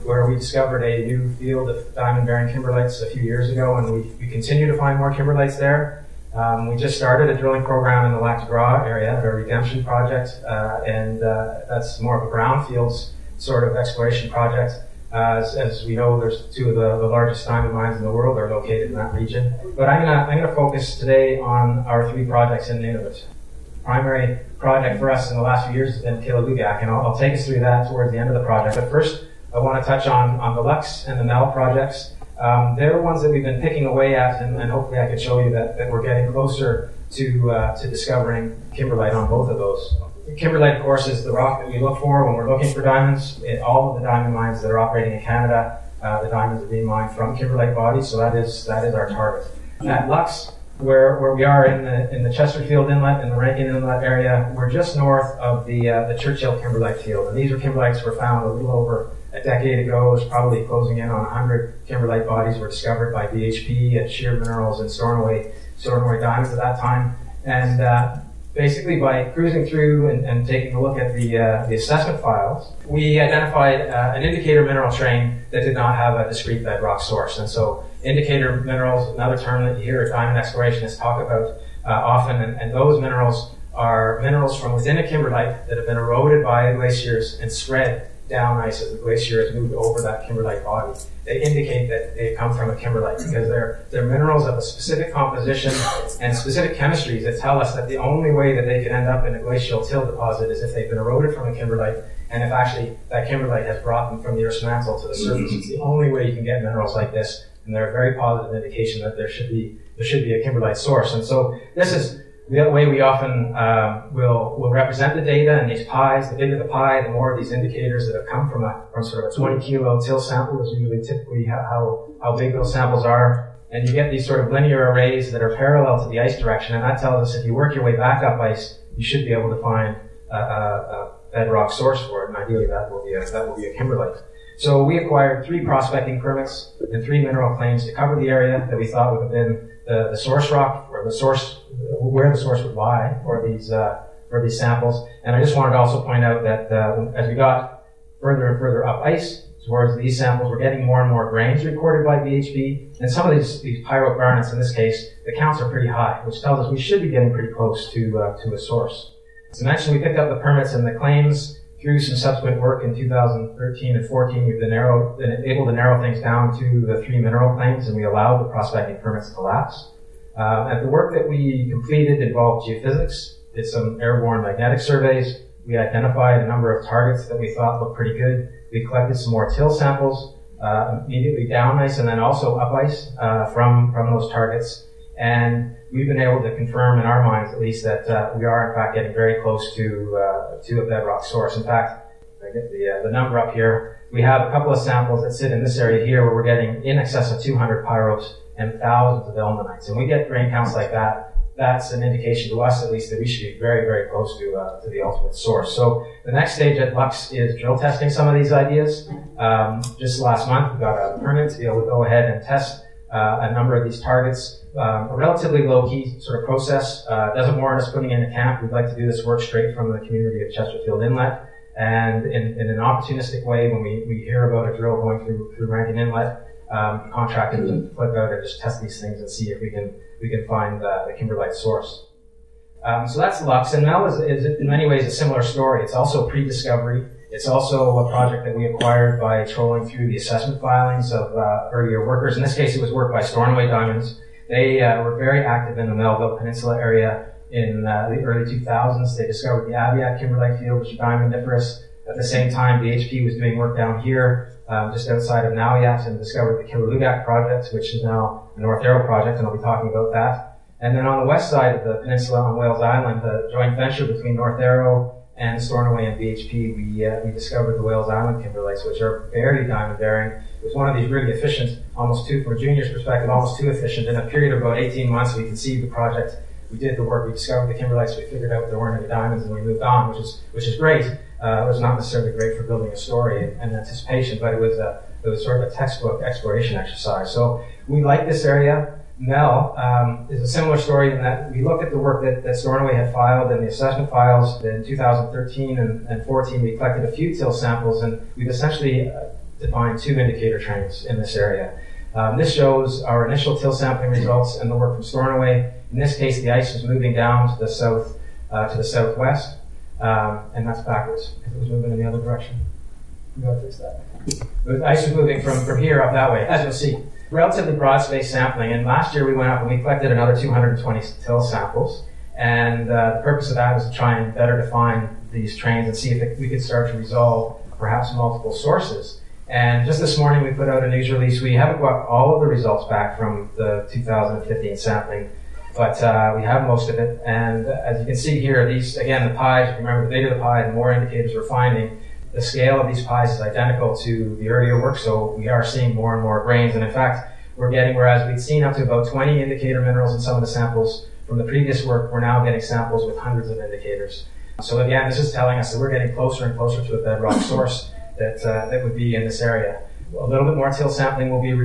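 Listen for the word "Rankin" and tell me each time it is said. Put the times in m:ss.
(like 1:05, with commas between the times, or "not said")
0:53, 3:45.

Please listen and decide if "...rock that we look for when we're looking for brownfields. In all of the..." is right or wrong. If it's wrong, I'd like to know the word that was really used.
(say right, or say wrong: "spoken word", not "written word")
wrong: "diamonds", not "brownfields".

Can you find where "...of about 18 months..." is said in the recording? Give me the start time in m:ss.
4:34.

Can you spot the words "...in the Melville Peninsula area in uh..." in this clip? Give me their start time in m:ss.
4:05.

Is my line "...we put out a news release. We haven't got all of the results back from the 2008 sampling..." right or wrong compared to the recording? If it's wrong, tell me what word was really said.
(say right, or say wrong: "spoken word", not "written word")
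wrong: "2015", not "2008".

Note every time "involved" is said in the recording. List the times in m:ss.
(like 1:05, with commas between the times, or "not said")
2:52.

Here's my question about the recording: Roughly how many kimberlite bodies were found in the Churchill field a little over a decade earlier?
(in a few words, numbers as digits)
100.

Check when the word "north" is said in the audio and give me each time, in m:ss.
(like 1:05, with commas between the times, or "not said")
0:54, 4:18, 4:24.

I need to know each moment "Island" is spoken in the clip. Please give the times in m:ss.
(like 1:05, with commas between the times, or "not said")
4:22, 4:28.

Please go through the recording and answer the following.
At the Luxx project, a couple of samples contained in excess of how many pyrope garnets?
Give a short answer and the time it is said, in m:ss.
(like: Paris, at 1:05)
200, at 3:17.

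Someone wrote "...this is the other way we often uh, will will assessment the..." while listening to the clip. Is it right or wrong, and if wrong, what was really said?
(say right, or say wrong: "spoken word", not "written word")
wrong: "represent", not "assessment".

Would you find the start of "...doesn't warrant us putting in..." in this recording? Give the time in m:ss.
3:37.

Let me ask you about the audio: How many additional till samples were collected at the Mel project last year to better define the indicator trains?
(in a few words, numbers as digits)
220.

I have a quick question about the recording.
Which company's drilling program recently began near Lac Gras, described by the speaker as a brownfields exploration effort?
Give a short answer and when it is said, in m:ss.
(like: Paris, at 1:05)
Redemption project, at 0:09.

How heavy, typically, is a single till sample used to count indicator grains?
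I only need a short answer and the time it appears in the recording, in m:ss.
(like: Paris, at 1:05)
20 kilo, at 1:59.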